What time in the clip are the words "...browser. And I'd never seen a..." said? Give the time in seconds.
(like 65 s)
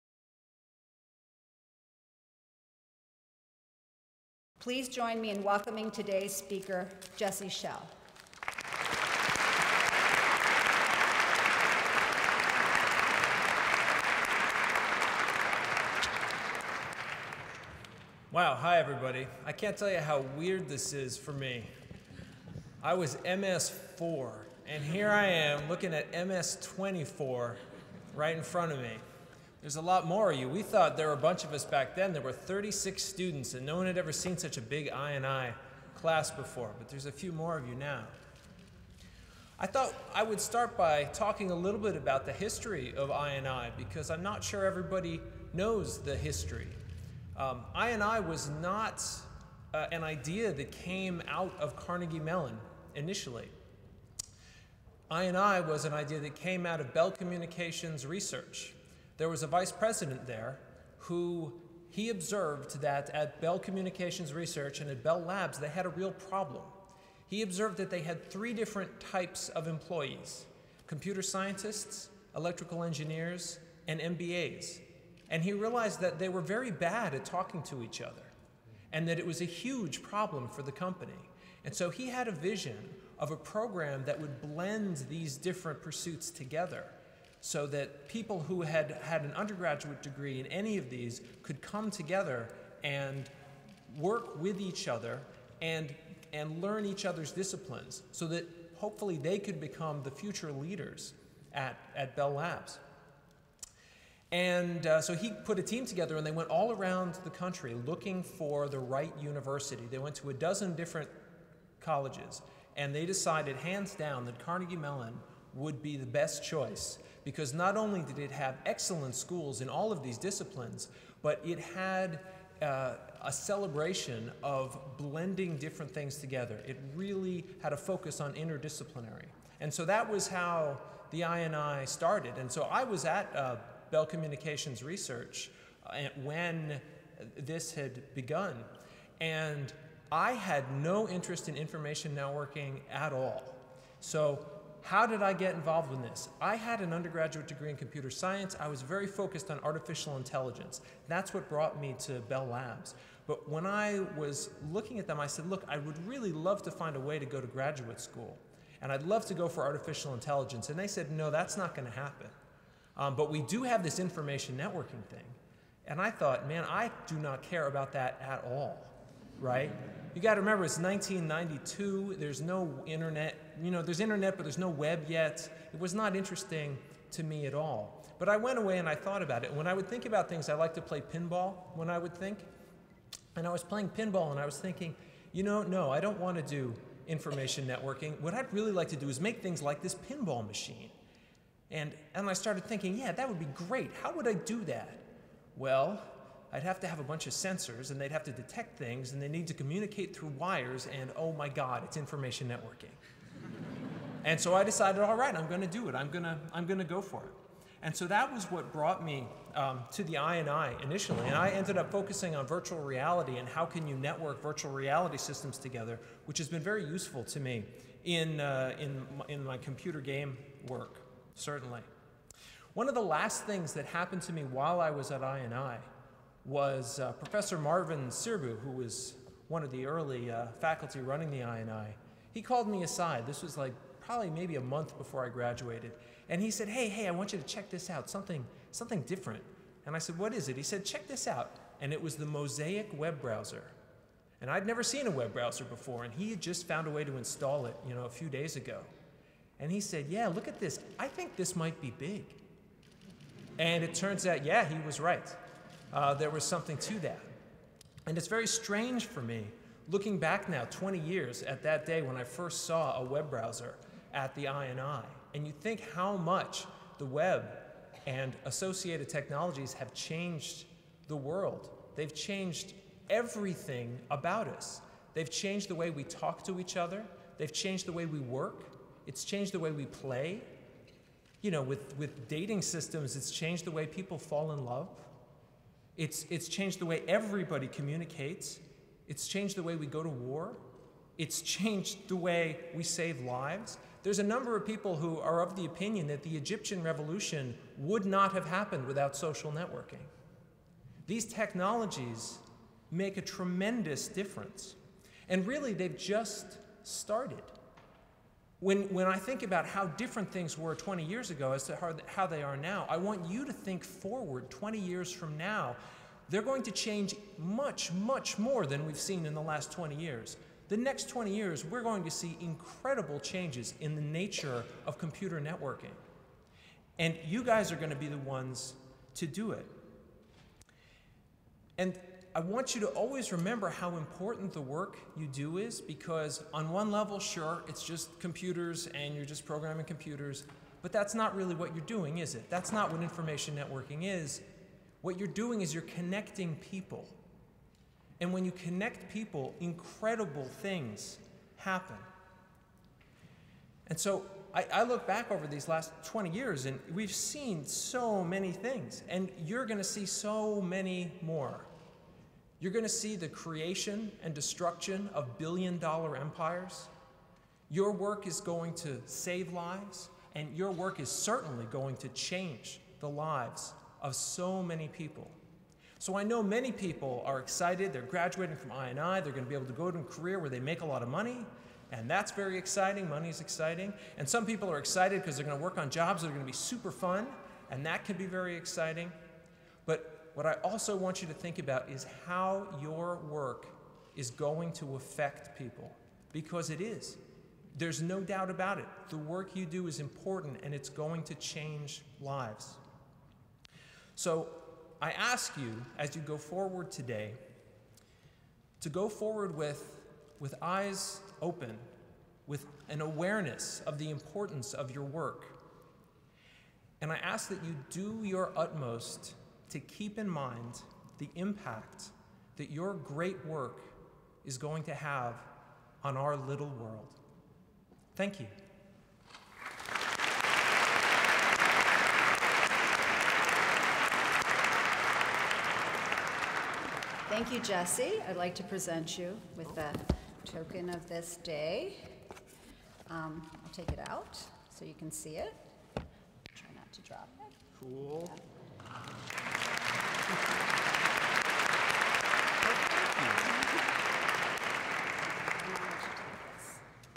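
243 s.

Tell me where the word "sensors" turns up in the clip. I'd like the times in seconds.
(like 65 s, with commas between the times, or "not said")
197 s.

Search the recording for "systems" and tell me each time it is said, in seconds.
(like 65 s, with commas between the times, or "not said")
215 s, 282 s.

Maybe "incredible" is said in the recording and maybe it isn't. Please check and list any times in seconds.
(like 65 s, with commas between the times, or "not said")
322 s, 349 s.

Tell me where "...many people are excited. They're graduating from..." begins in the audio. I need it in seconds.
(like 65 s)
376 s.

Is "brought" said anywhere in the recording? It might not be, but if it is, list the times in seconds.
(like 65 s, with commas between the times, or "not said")
151 s, 208 s.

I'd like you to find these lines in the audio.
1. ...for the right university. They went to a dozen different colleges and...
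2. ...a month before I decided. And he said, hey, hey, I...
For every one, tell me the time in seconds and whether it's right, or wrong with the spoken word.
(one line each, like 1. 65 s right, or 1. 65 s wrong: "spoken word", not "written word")
1. 108 s right
2. 234 s wrong: "graduated", not "decided".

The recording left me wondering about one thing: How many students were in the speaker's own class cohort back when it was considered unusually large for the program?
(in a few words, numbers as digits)
36.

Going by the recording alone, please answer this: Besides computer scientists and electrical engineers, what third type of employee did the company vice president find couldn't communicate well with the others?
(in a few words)
MBAs.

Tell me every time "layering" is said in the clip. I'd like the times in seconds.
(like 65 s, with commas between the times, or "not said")
not said.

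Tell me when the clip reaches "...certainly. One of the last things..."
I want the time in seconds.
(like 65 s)
221 s.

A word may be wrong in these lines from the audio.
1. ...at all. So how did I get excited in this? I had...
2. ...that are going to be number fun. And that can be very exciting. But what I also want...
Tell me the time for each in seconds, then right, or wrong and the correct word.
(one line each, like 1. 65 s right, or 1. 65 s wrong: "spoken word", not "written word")
1. 142 s wrong: "involved", not "excited"
2. 386 s wrong: "super", not "number".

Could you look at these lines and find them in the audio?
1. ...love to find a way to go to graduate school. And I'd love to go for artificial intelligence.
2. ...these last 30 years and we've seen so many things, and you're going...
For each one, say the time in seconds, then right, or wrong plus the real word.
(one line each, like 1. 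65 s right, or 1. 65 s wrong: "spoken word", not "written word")
1. 156 s right
2. 355 s wrong: "20", not "30".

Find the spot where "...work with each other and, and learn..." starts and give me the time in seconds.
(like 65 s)
93 s.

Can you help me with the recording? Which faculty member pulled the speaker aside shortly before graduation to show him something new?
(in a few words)
Marvin Sirbu.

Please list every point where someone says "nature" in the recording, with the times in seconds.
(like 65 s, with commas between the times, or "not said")
324 s.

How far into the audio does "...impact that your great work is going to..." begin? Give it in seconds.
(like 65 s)
421 s.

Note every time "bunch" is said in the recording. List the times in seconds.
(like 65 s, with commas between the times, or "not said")
31 s, 197 s.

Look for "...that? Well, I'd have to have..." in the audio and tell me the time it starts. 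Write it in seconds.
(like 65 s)
194 s.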